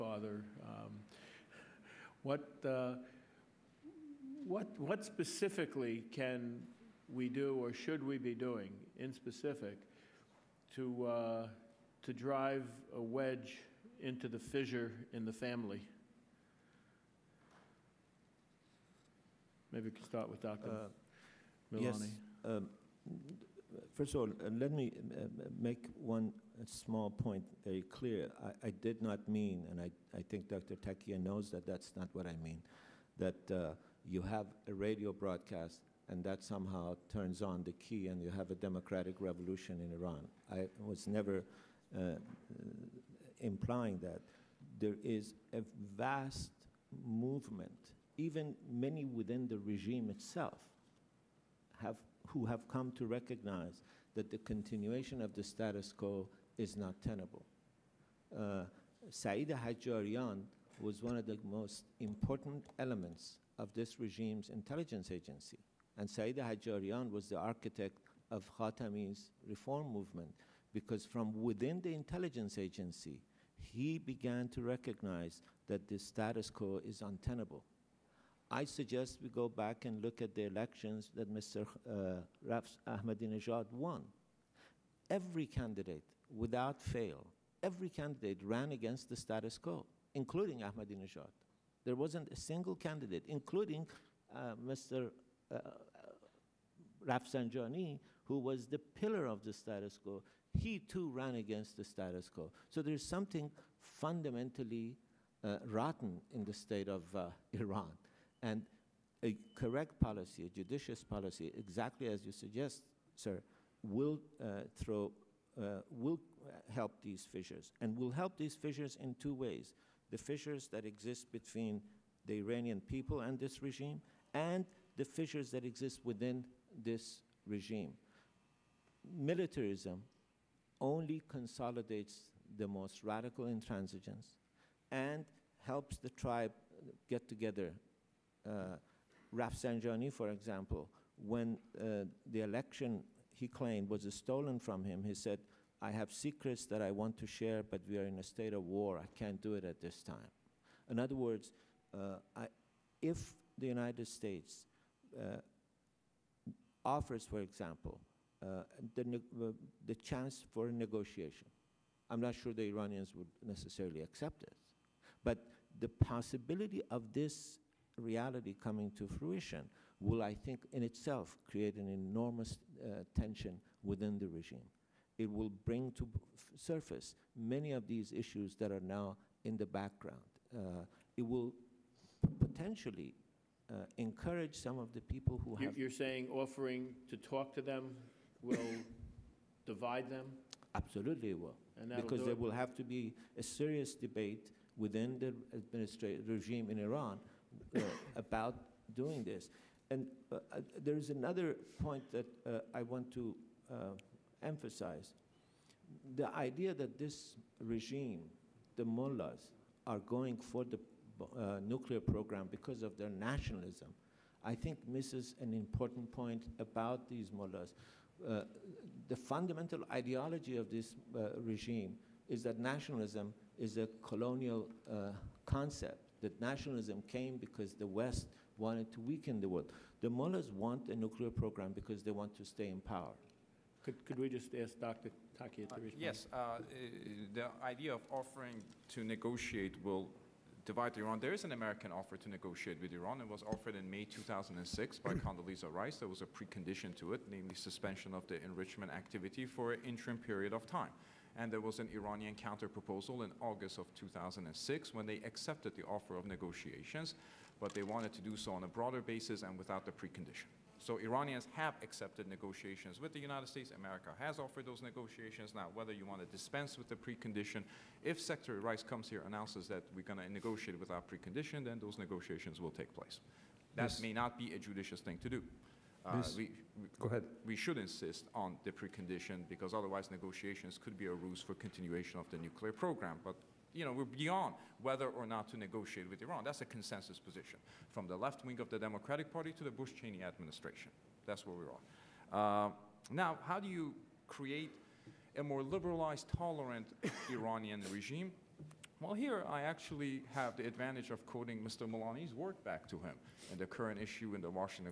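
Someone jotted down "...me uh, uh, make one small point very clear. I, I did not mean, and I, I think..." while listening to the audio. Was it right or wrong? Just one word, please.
right.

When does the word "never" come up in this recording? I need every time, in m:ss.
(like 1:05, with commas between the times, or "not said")
0:41.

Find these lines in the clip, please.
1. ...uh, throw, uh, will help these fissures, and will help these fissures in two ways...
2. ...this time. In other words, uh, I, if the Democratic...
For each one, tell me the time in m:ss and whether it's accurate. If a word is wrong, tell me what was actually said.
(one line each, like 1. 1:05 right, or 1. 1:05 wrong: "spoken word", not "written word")
1. 1:54 right
2. 2:29 wrong: "United", not "Democratic".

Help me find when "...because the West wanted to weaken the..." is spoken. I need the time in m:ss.
3:47.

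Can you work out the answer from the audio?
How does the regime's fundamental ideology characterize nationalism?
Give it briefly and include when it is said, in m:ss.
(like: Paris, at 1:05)
colonial, at 3:44.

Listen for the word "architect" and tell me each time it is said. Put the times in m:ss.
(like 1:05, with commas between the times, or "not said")
1:07.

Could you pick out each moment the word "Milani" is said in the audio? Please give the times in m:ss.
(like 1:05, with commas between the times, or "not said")
0:21, 5:01.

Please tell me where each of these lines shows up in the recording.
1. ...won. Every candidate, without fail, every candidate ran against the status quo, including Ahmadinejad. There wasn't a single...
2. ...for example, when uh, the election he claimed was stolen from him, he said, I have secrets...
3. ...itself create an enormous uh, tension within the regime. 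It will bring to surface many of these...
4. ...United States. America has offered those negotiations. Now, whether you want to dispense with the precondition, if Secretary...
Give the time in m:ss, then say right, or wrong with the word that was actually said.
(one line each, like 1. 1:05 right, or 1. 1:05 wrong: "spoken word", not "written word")
1. 1:23 right
2. 2:20 right
3. 2:50 right
4. 4:23 right.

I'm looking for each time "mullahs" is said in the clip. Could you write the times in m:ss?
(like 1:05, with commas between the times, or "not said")
3:28, 3:37, 3:50.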